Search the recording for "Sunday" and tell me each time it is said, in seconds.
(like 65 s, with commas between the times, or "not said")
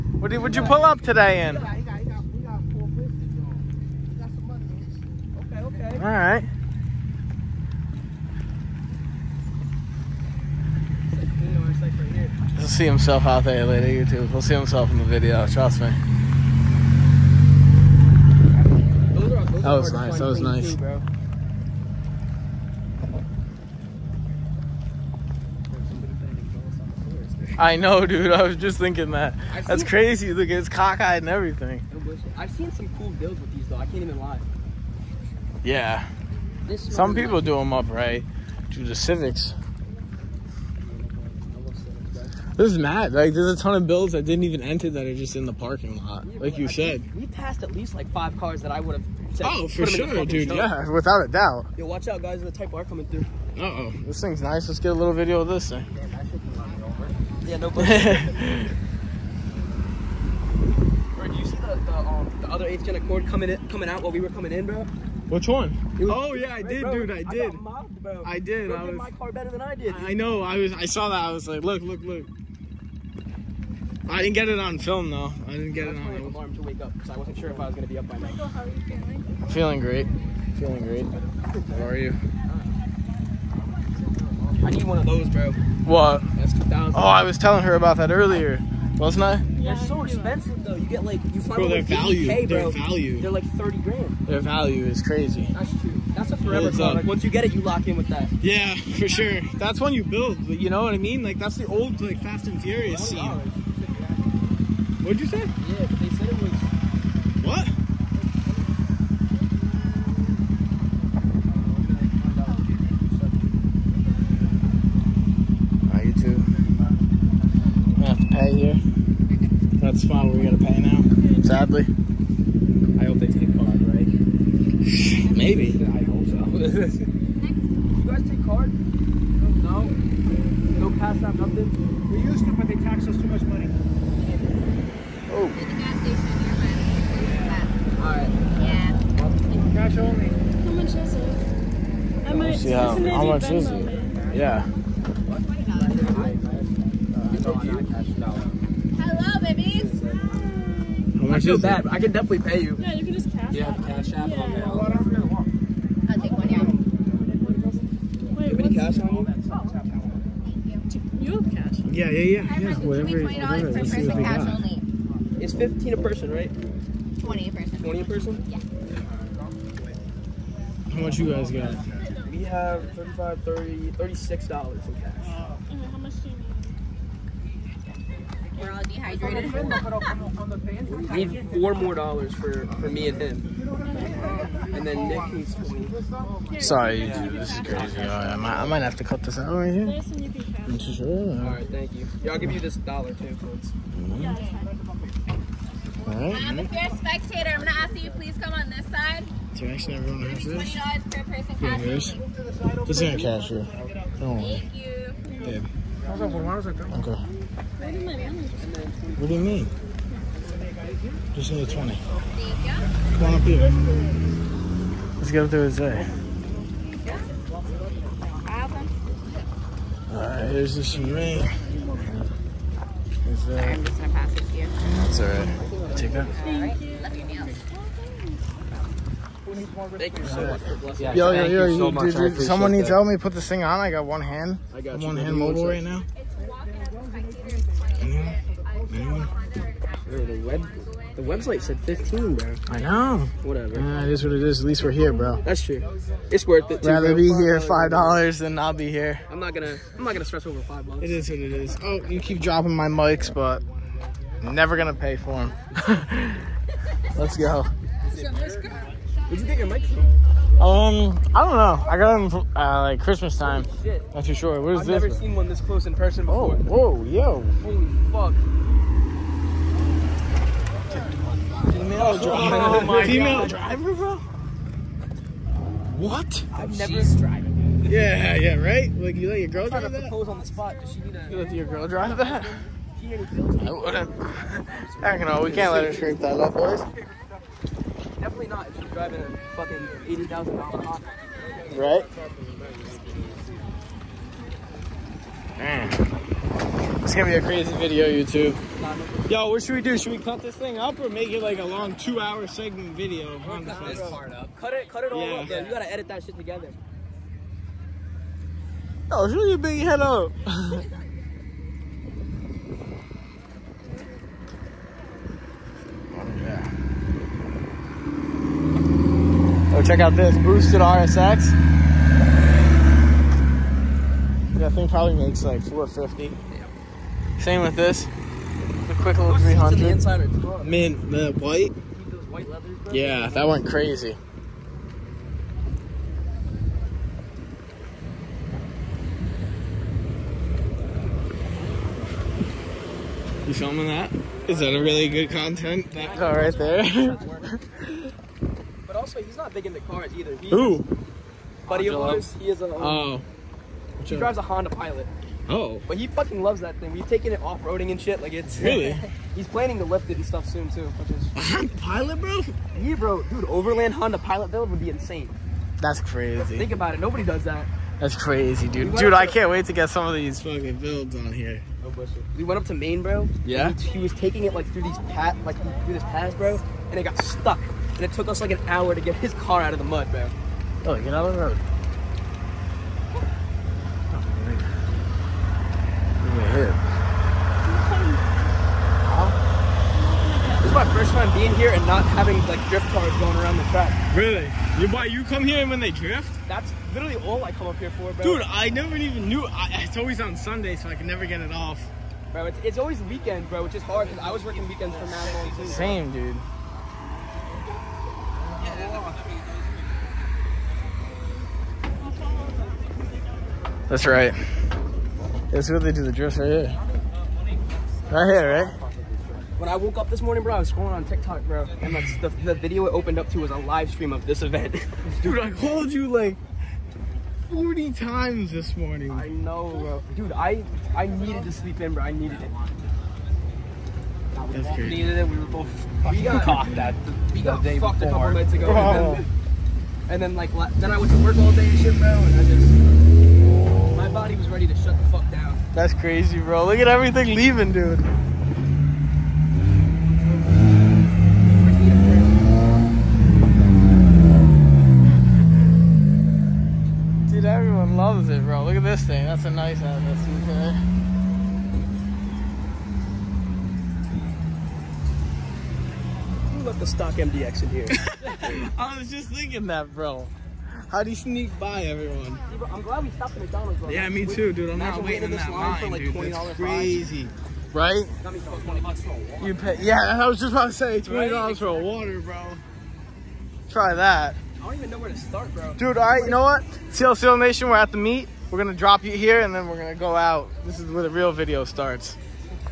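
400 s.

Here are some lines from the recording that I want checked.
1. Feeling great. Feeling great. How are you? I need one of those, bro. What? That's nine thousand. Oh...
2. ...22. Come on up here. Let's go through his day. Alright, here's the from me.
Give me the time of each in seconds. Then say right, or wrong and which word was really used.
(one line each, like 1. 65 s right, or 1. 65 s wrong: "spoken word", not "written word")
1. 79 s wrong: "two", not "nine"
2. 211 s wrong: "20", not "22".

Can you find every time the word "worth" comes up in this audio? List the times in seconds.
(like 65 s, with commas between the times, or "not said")
246 s.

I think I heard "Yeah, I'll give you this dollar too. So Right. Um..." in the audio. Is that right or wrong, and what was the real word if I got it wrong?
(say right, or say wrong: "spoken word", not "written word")
right.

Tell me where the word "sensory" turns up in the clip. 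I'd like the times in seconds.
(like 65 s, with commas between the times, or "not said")
not said.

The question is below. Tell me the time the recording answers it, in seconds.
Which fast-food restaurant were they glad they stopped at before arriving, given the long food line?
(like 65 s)
473 s.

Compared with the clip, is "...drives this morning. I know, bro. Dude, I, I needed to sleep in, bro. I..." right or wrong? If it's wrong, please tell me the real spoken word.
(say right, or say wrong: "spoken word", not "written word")
wrong: "times", not "drives".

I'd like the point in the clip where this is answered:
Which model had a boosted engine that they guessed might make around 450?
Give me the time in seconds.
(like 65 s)
320 s.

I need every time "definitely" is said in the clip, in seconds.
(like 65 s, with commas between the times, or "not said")
152 s, 288 s.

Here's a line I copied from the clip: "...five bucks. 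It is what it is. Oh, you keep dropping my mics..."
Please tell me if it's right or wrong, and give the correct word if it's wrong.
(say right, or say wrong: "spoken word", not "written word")
right.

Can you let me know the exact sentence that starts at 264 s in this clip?
I've never seen one this close in person oh, before.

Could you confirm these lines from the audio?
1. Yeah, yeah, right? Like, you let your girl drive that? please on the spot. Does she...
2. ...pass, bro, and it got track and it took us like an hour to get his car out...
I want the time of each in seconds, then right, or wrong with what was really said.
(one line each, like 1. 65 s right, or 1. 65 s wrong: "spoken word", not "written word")
1. 277 s wrong: "propose", not "please"
2. 376 s wrong: "stuck", not "track".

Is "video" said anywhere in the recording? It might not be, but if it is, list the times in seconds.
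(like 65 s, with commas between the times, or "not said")
15 s, 55 s, 297 s, 302 s, 422 s, 491 s.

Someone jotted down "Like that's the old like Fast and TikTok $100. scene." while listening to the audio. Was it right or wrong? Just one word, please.
wrong.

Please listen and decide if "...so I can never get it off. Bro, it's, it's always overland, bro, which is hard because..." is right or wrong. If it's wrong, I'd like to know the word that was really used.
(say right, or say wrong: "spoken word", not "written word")
wrong: "weekend", not "overland".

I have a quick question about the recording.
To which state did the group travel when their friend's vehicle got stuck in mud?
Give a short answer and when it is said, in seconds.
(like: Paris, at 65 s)
Maine, at 372 s.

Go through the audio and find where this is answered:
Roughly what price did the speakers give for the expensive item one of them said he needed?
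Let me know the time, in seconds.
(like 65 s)
93 s.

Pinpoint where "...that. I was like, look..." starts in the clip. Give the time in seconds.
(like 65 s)
71 s.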